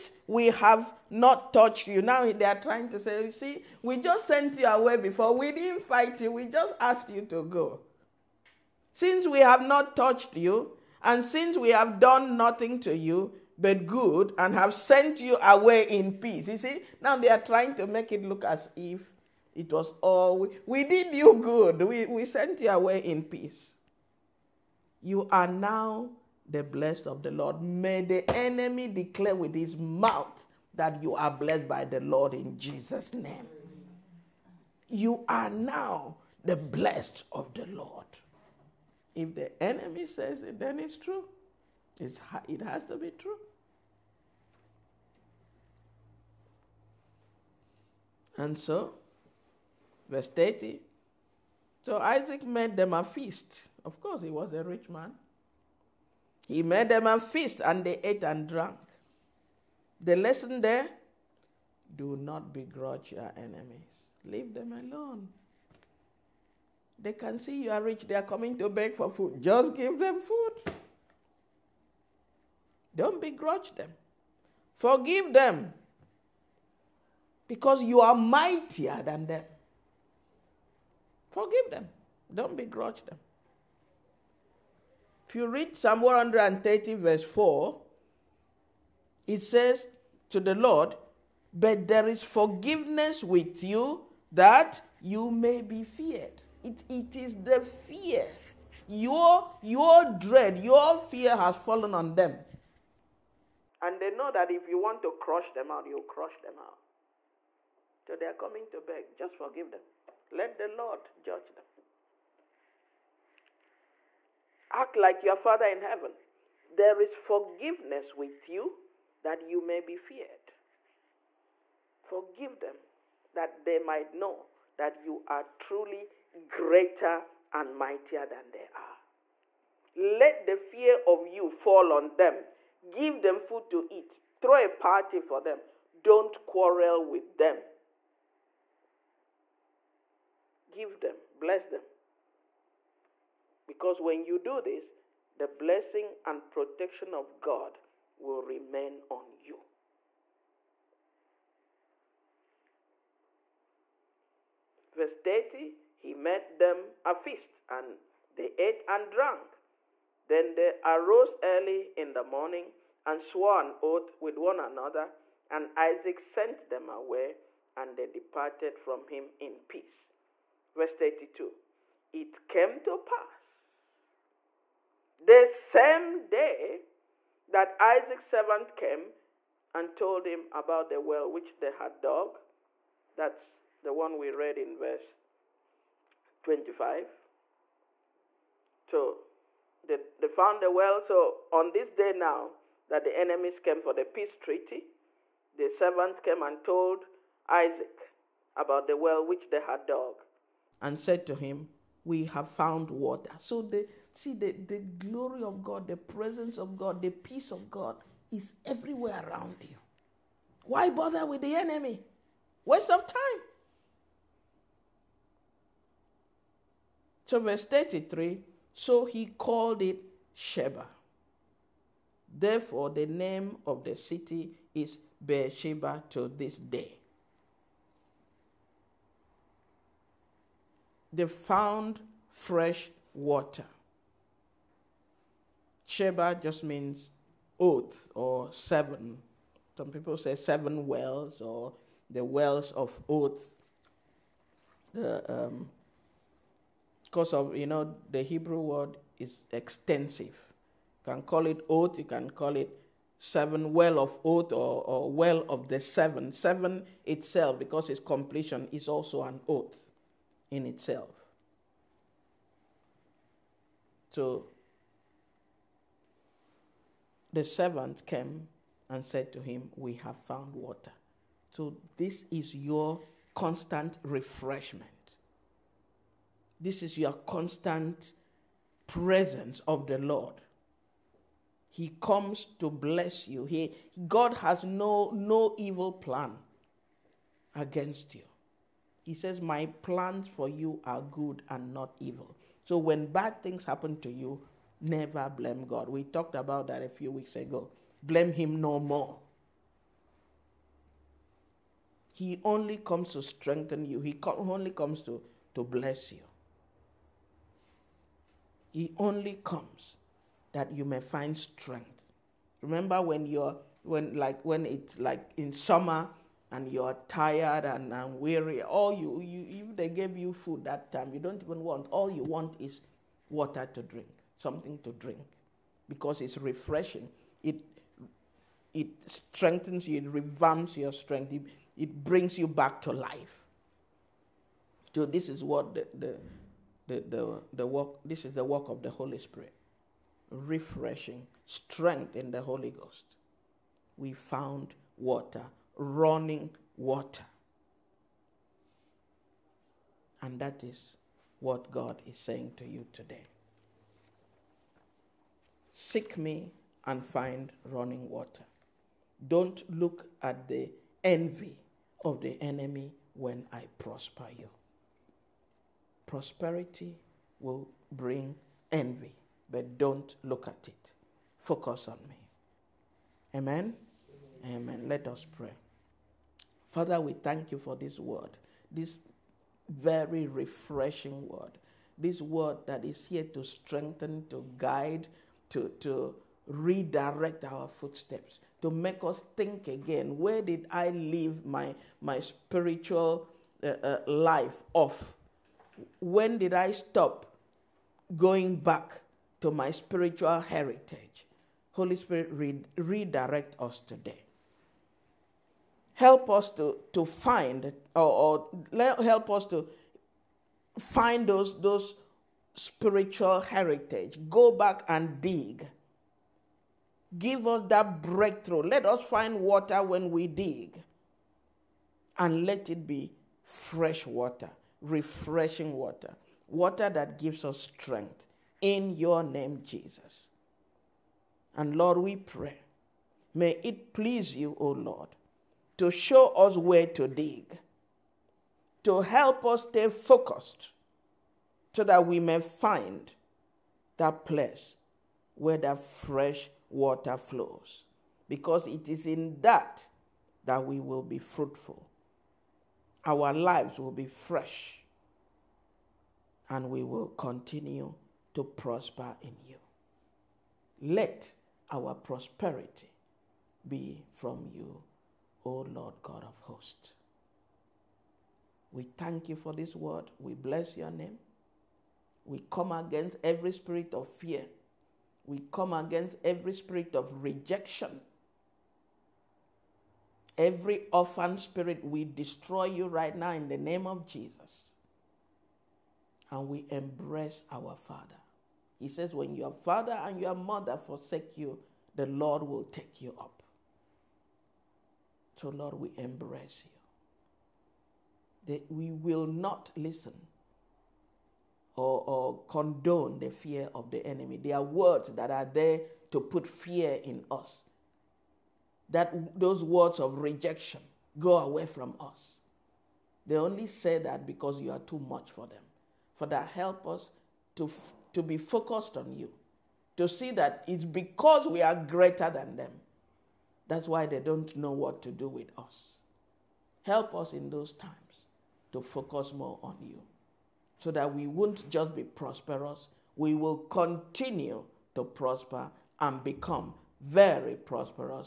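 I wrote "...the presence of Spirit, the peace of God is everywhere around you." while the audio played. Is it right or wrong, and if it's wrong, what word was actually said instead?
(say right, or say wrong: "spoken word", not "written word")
wrong: "God", not "Spirit".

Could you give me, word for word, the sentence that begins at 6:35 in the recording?
When did I stop going back to my spiritual heritage?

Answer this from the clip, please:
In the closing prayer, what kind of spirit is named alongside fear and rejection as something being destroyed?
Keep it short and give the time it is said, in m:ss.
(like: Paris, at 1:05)
Orphan spirit, at 8:00.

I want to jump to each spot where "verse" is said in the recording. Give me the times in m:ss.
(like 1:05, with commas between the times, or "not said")
0:50, 1:26, 2:34, 2:50, 3:04, 3:37.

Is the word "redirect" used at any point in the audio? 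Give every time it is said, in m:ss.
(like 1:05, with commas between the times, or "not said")
6:26, 6:42.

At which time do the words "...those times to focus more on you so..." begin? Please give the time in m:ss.
8:47.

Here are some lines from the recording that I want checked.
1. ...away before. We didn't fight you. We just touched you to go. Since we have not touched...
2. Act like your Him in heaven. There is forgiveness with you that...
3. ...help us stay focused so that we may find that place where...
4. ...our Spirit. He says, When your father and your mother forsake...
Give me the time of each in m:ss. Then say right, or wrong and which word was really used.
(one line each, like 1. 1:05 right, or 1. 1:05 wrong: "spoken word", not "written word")
1. 0:04 wrong: "asked", not "touched"
2. 1:54 wrong: "Father", not "Him"
3. 7:18 right
4. 8:07 wrong: "Father", not "Spirit".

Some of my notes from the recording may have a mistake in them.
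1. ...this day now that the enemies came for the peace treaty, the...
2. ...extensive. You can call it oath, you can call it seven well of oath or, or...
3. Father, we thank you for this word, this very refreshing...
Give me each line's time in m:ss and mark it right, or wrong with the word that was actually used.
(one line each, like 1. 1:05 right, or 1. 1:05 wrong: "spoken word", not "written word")
1. 3:11 right
2. 4:09 right
3. 6:16 right.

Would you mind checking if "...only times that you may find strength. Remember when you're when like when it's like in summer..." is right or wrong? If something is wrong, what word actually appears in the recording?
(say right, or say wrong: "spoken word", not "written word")
wrong: "comes", not "times".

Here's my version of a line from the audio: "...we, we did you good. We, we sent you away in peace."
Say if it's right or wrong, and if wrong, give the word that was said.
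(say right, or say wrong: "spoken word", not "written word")
right.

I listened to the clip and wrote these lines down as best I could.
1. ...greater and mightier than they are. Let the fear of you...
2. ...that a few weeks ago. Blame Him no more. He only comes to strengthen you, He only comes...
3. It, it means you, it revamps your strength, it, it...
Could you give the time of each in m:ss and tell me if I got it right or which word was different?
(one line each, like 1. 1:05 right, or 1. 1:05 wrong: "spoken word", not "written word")
1. 2:06 right
2. 4:56 right
3. 5:27 wrong: "strengthens", not "means".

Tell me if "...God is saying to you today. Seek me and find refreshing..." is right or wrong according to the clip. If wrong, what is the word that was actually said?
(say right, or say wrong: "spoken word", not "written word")
wrong: "running", not "refreshing".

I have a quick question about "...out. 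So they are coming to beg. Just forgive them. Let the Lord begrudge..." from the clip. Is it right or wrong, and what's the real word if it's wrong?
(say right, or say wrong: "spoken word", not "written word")
wrong: "judge", not "begrudge".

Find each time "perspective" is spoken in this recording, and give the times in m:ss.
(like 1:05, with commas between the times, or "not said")
not said.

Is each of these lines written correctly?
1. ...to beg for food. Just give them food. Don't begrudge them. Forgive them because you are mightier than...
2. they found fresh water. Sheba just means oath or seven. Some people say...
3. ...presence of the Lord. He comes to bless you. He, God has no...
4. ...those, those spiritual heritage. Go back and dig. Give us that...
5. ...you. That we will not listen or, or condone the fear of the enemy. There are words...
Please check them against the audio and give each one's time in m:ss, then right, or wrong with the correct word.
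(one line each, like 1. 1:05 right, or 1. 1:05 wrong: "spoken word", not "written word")
1. 1:08 right
2. 3:51 right
3. 4:38 right
4. 6:51 right
5. 8:16 right.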